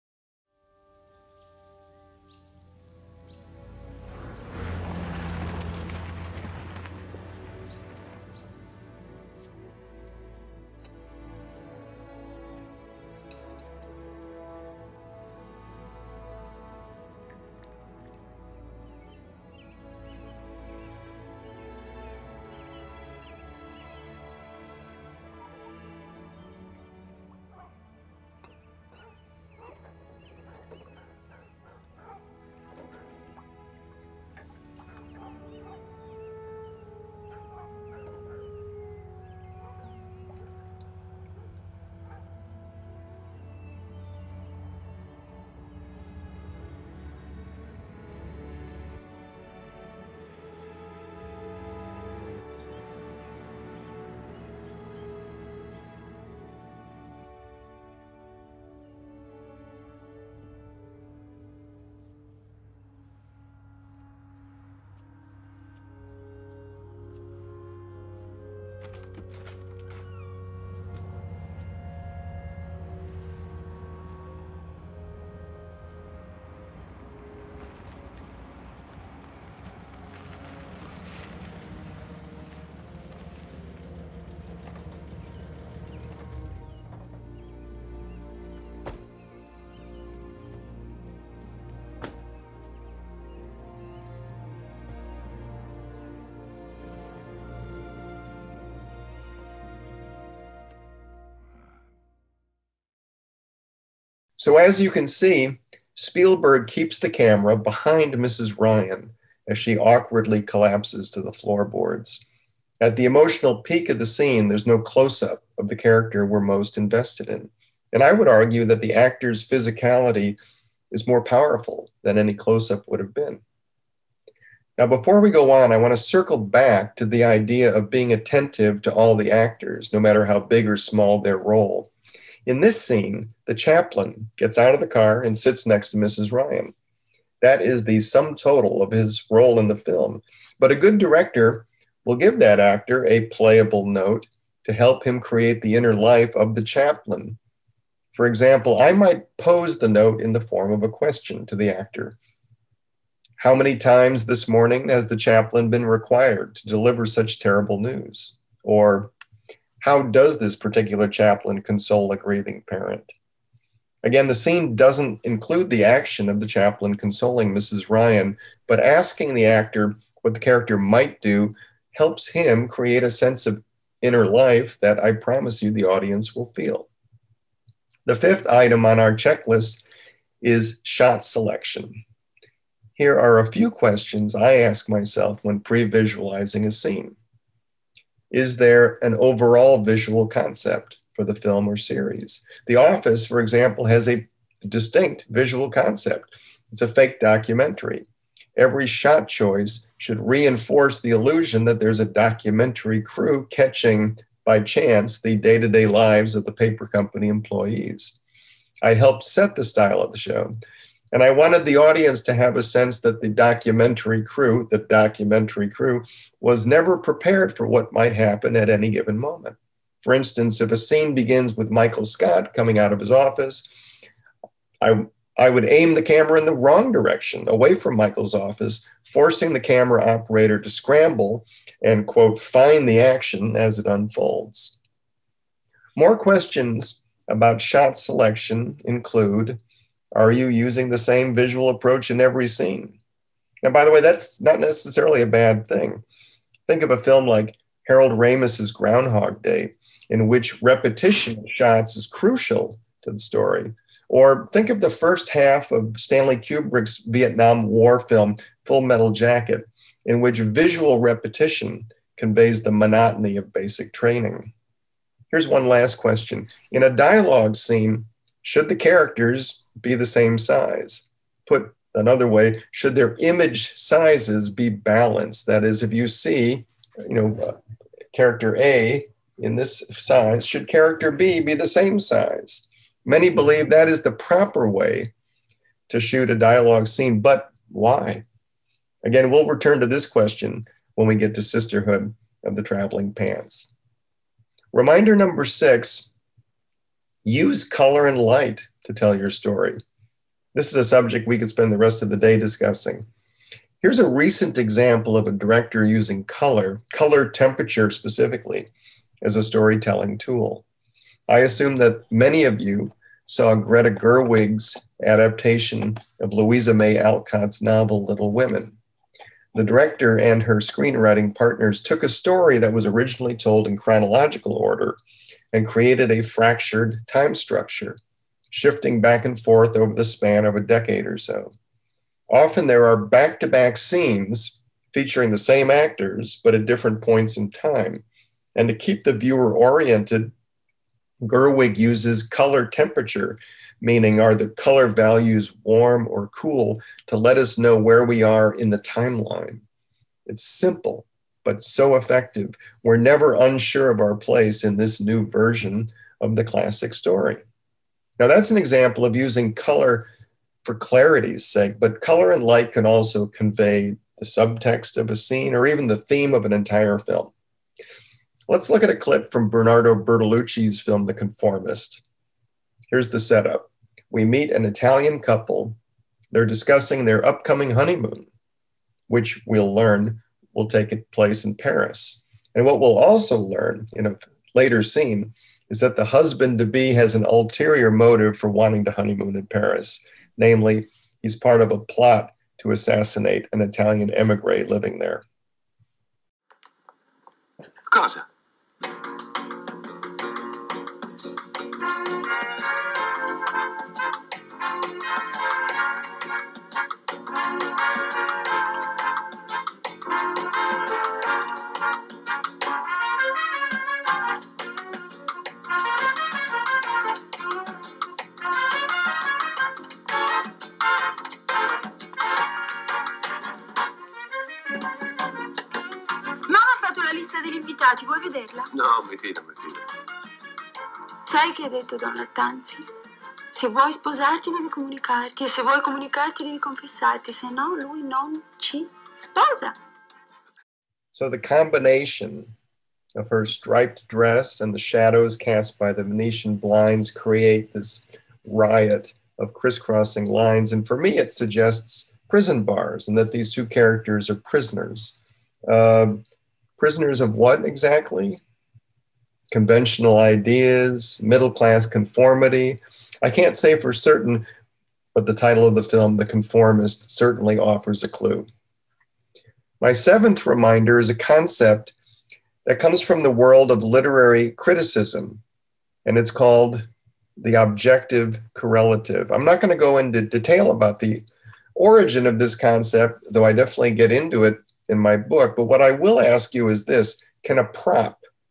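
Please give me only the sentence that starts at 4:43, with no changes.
Many believe that is the proper way to shoot a dialogue scene, but why?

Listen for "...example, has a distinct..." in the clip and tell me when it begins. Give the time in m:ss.
3:13.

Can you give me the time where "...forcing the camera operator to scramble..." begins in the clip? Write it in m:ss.
3:49.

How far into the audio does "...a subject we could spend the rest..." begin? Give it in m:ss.
5:00.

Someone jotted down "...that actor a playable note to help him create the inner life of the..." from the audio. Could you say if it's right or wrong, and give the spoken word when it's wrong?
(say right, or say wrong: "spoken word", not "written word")
right.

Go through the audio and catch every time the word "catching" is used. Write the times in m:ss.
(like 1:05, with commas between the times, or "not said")
3:23.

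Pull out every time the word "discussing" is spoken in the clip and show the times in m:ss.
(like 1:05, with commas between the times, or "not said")
5:02, 6:16.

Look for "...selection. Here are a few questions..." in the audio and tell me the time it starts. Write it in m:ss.
3:01.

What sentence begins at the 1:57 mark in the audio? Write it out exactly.
And I would argue that the actor's physicality is more powerful than any close up would have been.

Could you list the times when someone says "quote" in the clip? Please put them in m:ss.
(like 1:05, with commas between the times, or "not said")
3:52.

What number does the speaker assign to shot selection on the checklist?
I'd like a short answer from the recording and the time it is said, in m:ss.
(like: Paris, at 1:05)
5, at 2:58.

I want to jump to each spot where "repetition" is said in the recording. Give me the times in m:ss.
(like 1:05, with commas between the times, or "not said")
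4:10, 4:20.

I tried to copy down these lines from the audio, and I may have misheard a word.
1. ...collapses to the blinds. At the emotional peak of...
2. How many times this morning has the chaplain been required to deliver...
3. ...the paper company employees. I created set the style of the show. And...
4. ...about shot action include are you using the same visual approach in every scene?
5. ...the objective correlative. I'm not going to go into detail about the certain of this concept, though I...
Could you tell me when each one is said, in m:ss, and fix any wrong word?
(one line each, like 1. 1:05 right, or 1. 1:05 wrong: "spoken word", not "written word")
1. 1:50 wrong: "floorboards", not "blinds"
2. 2:33 right
3. 3:26 wrong: "helped", not "created"
4. 3:57 wrong: "selection", not "action"
5. 7:57 wrong: "origin", not "certain".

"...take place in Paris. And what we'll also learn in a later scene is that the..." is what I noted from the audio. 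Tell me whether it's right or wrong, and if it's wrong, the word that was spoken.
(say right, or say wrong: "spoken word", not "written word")
right.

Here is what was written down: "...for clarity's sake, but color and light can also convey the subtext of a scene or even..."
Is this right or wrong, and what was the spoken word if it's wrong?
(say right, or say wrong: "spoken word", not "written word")
right.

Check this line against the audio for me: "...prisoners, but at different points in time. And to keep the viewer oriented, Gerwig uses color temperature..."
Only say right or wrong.
wrong.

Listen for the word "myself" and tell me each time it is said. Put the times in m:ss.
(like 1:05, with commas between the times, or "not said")
3:04.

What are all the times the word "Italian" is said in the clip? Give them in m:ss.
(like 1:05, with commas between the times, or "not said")
6:14, 6:33.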